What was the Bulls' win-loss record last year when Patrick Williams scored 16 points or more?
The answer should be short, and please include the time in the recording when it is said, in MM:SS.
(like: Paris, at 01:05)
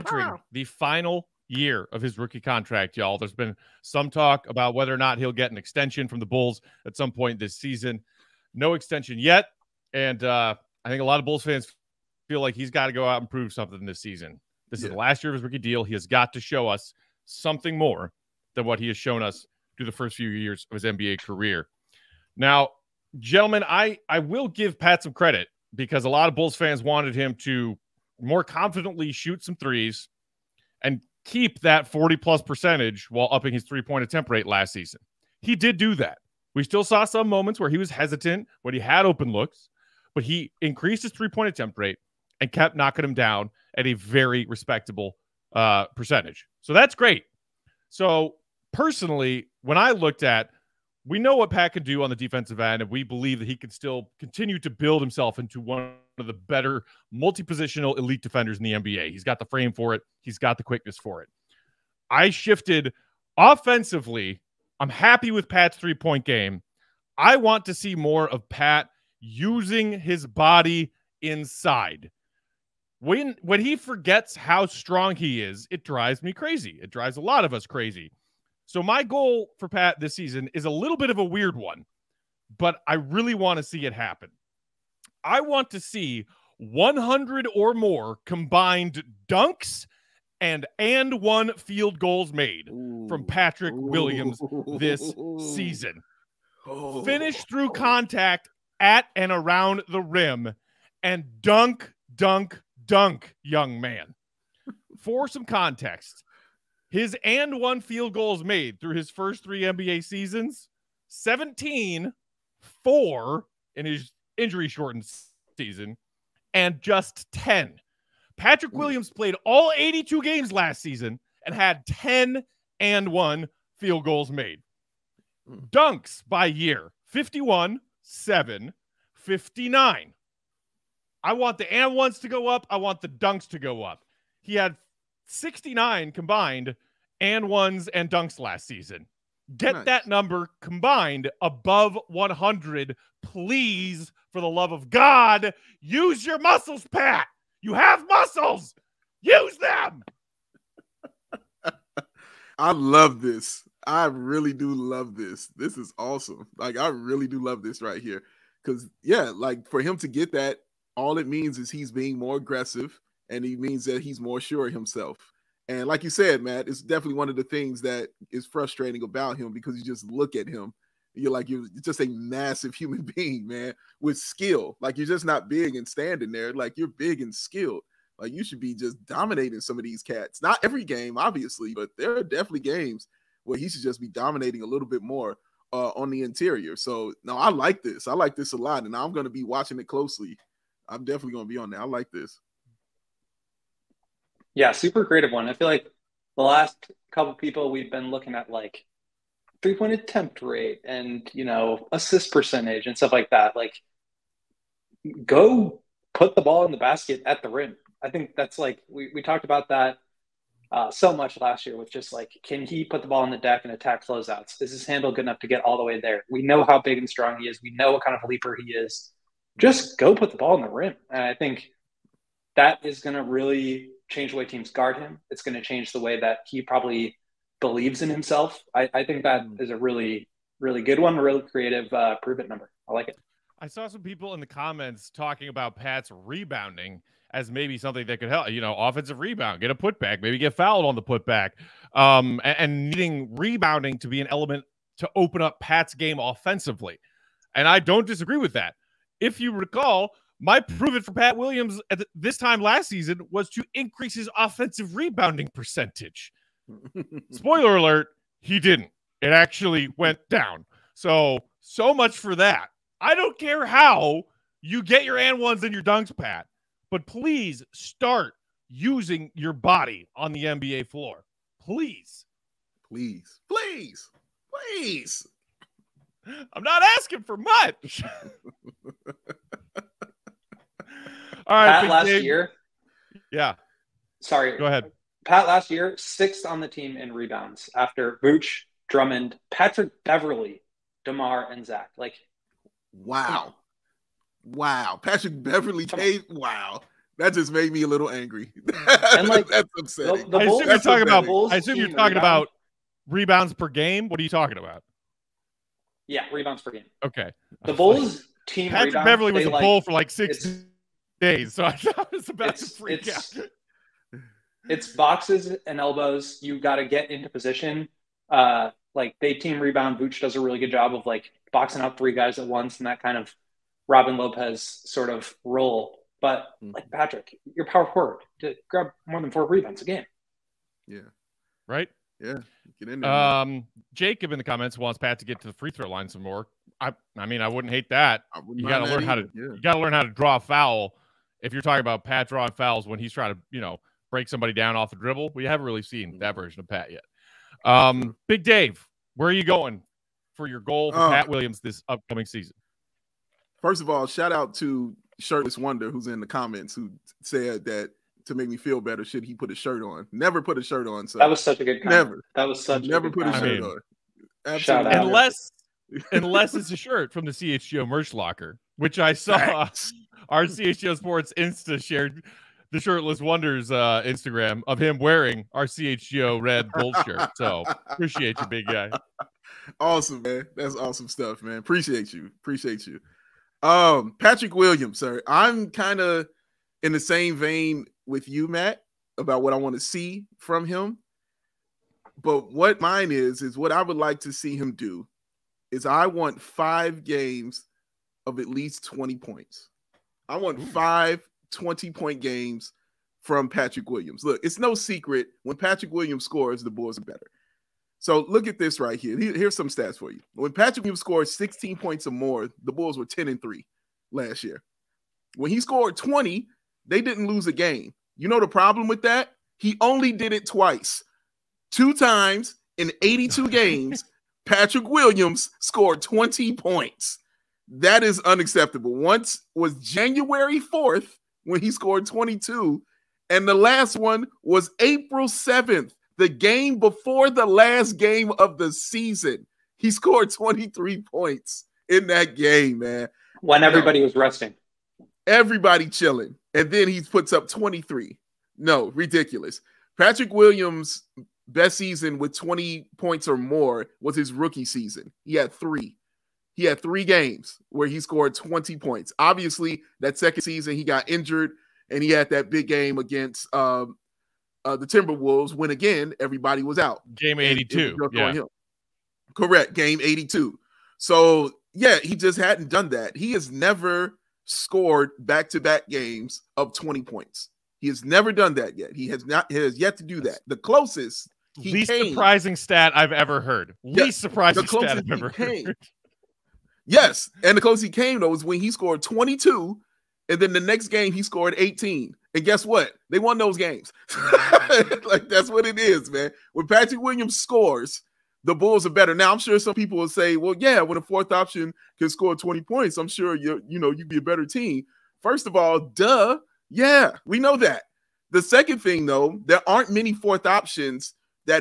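10 and 3, at 06:53.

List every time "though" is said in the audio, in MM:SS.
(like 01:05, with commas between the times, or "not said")
08:08, 08:29.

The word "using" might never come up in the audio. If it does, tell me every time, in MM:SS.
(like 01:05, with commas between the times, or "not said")
01:09, 04:28.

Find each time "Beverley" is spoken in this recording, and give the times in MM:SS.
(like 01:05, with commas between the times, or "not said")
04:50, 04:55, 05:09.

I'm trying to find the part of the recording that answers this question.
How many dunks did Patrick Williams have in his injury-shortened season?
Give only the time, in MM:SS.
02:08.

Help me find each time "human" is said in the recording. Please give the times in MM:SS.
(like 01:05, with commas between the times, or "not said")
02:52.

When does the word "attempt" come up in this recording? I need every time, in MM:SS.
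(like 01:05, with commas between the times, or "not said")
00:34, 00:41, 03:19.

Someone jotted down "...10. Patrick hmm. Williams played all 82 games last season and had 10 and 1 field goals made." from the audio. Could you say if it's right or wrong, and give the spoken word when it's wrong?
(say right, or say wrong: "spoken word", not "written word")
right.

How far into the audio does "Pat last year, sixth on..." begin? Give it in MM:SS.
04:45.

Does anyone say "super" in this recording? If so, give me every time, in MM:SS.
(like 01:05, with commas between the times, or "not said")
03:14.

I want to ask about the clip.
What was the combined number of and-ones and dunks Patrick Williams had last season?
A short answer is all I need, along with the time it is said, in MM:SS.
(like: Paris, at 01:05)
69, at 02:15.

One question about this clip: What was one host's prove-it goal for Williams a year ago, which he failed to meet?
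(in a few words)
Offensive rebounding percentage.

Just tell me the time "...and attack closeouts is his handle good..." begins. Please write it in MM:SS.
03:33.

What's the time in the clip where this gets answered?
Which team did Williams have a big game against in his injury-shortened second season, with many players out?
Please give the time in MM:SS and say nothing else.
07:44.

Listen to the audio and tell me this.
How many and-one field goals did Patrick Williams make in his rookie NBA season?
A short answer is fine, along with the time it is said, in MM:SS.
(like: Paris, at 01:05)
17, at 01:51.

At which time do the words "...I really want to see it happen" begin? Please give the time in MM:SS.
01:22.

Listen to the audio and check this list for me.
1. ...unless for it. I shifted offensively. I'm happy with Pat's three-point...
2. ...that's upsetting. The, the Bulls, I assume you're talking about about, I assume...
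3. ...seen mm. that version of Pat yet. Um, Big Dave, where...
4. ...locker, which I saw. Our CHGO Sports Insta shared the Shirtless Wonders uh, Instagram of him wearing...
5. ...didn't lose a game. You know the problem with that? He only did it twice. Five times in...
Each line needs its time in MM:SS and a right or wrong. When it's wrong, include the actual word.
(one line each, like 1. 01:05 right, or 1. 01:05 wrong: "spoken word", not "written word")
1. 01:00 wrong: "quickness", not "unless"
2. 04:59 right
3. 05:45 right
4. 06:08 right
5. 06:57 wrong: "Two", not "Five".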